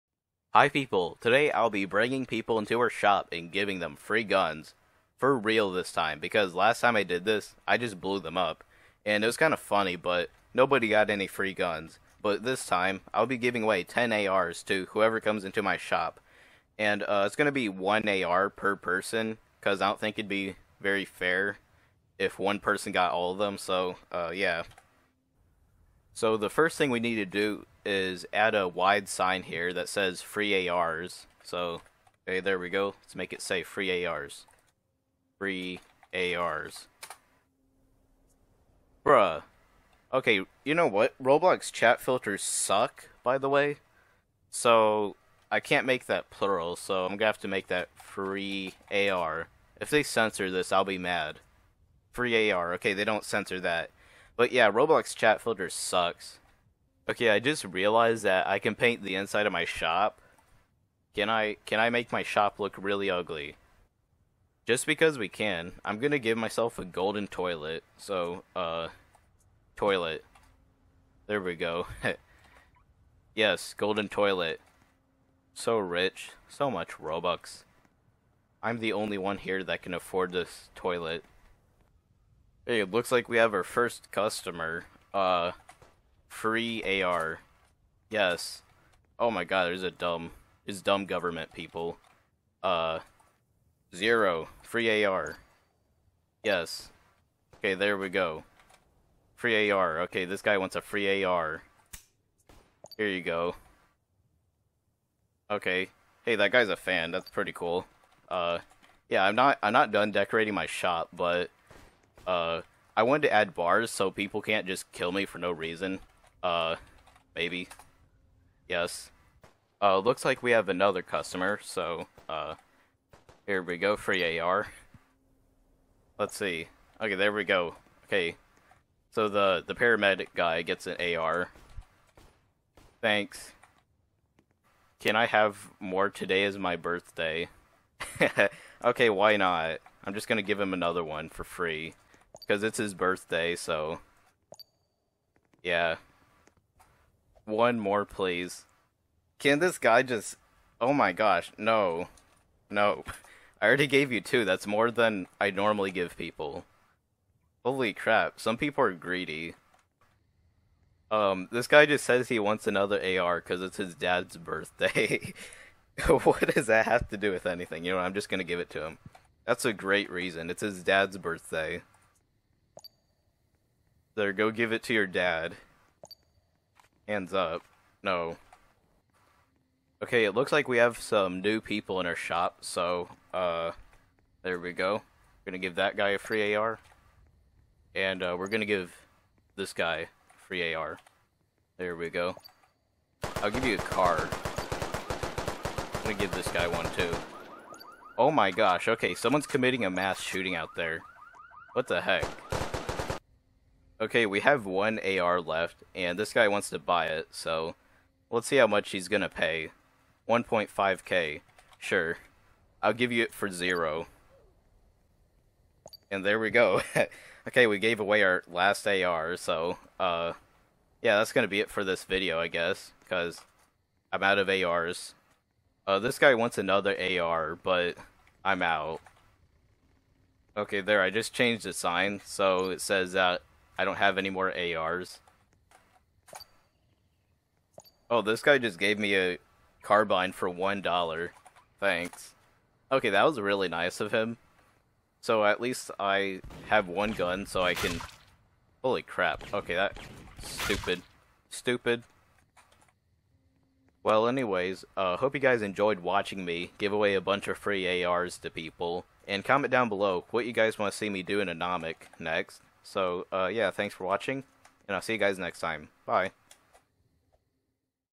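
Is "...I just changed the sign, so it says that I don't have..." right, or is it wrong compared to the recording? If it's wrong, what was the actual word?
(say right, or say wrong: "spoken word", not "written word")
right.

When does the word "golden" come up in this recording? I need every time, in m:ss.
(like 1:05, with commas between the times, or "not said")
1:06, 1:13.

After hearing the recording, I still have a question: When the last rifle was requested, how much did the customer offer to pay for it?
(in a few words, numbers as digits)
1.5k.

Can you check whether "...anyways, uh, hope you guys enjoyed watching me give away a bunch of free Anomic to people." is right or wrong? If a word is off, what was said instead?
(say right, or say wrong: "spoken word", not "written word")
wrong: "ARs", not "Anomic".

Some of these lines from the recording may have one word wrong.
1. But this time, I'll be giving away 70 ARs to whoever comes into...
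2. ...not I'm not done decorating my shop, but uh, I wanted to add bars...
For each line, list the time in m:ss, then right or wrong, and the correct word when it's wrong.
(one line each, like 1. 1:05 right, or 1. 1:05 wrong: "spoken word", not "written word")
1. 0:12 wrong: "10", not "70"
2. 1:49 right.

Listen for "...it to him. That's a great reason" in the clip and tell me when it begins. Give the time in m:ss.
2:48.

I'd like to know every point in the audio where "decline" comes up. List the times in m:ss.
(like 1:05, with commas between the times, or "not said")
not said.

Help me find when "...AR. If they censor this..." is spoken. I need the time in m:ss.
0:48.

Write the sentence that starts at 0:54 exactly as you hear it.
But yeah, Roblox chat filter sucks.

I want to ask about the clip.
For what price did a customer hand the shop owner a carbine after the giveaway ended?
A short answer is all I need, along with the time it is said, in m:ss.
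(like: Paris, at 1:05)
one dollar, at 4:00.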